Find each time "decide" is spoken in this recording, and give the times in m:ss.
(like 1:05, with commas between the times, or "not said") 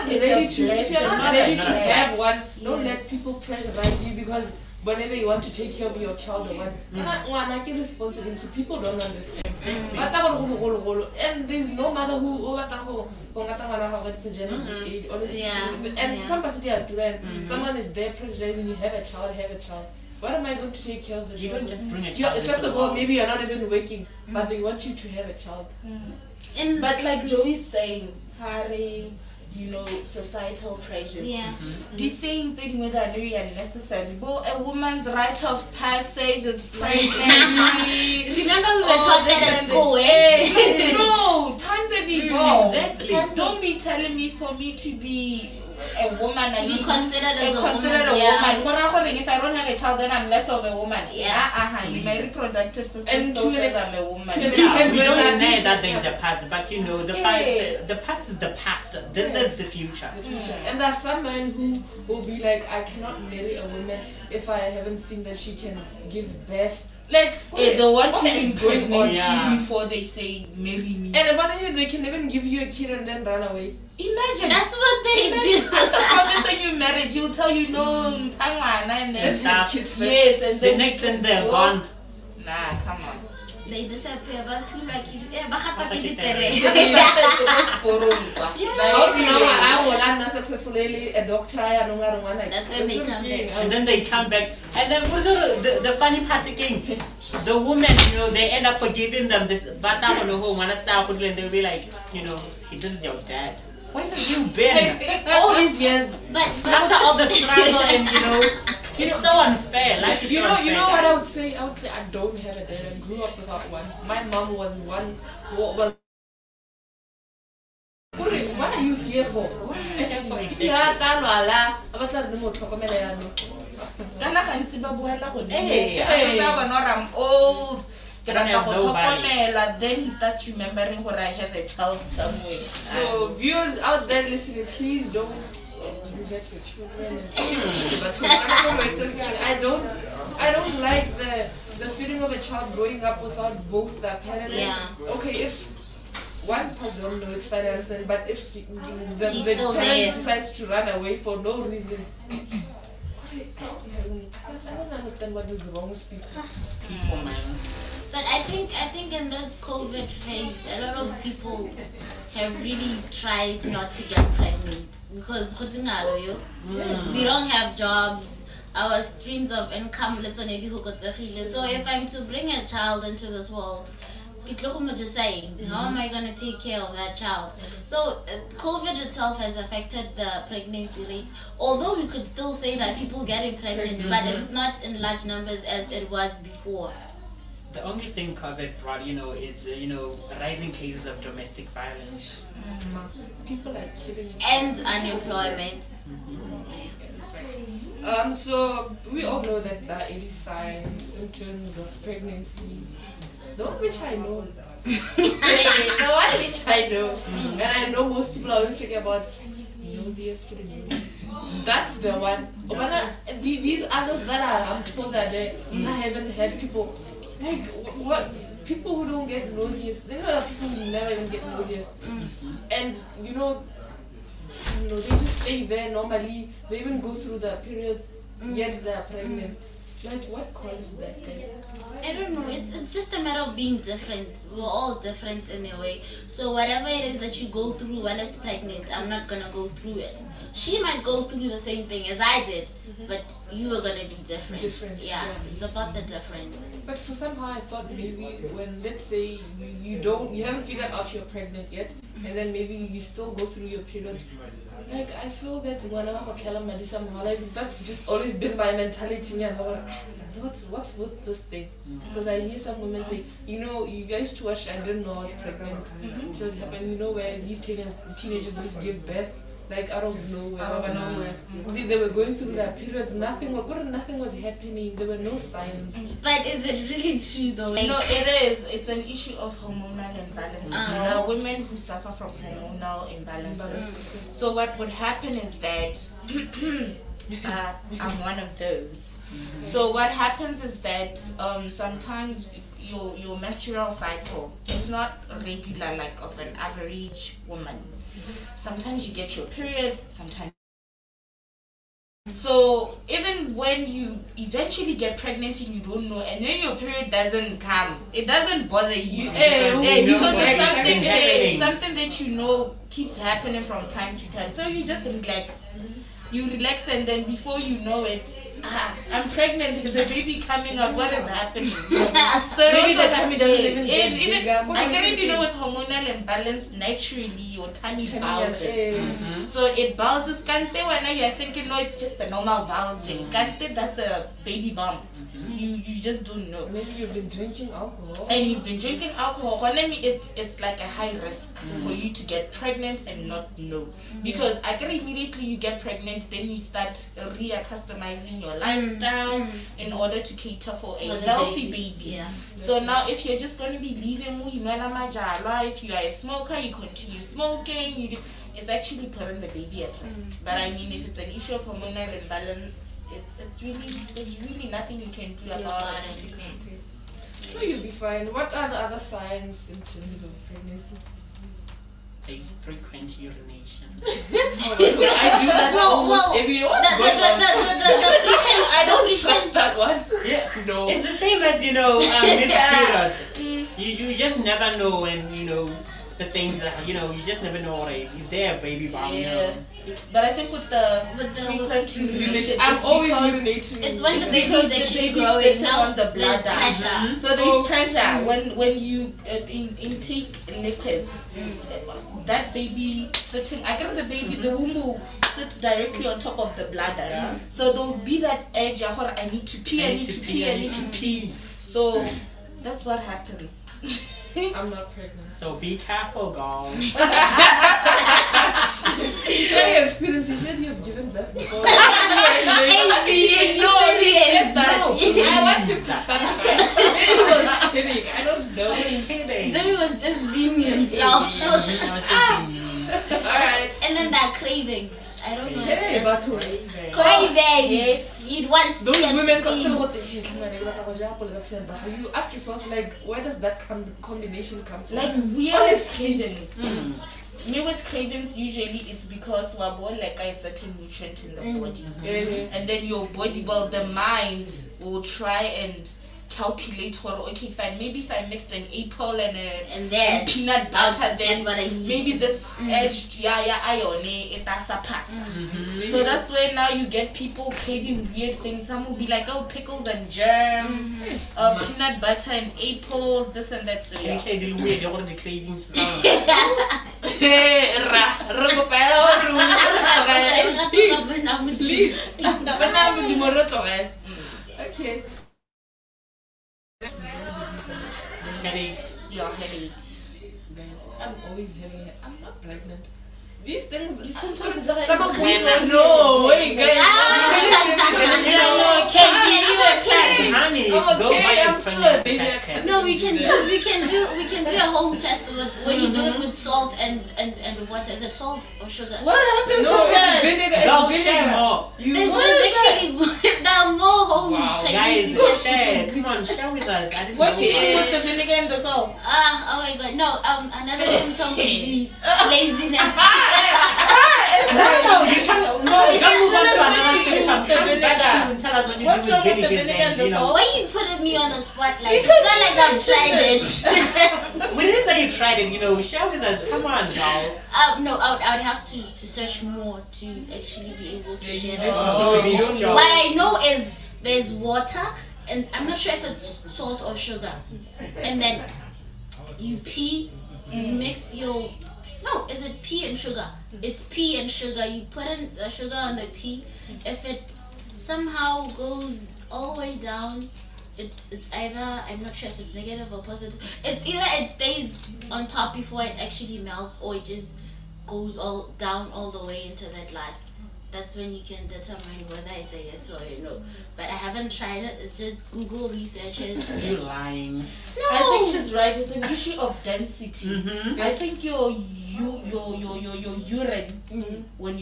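1:23, 2:30.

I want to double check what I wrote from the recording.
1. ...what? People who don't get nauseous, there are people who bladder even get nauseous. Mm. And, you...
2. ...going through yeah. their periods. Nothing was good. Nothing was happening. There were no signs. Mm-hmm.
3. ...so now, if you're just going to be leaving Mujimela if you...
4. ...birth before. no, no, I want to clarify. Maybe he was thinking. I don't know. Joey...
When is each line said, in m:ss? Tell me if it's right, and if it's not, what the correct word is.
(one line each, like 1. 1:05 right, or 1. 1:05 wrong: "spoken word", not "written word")
1. 3:38 wrong: "never", not "bladder"
2. 4:32 right
3. 5:52 right
4. 7:01 wrong: "kidding", not "thinking".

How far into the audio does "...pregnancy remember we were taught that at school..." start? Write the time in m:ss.
0:36.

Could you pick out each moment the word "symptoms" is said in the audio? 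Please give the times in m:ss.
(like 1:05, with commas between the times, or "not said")
6:09, 8:40.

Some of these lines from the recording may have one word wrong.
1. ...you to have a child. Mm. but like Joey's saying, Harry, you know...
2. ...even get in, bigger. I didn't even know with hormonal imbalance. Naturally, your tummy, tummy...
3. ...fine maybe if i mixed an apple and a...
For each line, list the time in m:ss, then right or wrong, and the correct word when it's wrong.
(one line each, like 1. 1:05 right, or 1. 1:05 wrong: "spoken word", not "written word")
1. 0:24 right
2. 5:23 right
3. 7:37 right.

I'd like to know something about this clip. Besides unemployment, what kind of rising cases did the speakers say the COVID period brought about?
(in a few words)
Domestic violence.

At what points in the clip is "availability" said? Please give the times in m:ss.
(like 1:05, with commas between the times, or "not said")
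not said.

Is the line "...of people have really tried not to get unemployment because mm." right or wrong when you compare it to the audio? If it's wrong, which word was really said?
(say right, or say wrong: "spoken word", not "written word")
wrong: "pregnant", not "unemployment".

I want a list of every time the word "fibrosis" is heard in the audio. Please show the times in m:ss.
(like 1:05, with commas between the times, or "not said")
not said.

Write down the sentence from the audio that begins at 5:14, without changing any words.
So you just relax, you relax, and then before you know it, ah, I'm pregnant.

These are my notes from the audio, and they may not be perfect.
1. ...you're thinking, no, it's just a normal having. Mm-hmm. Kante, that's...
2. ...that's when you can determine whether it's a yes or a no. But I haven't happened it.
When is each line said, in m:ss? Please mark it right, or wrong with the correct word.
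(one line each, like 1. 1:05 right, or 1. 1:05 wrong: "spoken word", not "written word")
1. 5:31 wrong: "bulging", not "having"
2. 9:30 wrong: "tried", not "happened".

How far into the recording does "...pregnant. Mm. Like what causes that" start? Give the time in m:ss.
3:49.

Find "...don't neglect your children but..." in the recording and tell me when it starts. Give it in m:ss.
2:15.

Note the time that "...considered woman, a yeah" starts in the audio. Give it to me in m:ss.
0:47.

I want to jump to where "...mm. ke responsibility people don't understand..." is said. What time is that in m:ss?
0:07.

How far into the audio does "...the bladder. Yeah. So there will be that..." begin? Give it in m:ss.
6:46.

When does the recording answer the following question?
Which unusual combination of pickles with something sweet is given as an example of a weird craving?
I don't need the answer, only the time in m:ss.
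7:49.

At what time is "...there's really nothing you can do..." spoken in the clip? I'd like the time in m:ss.
6:04.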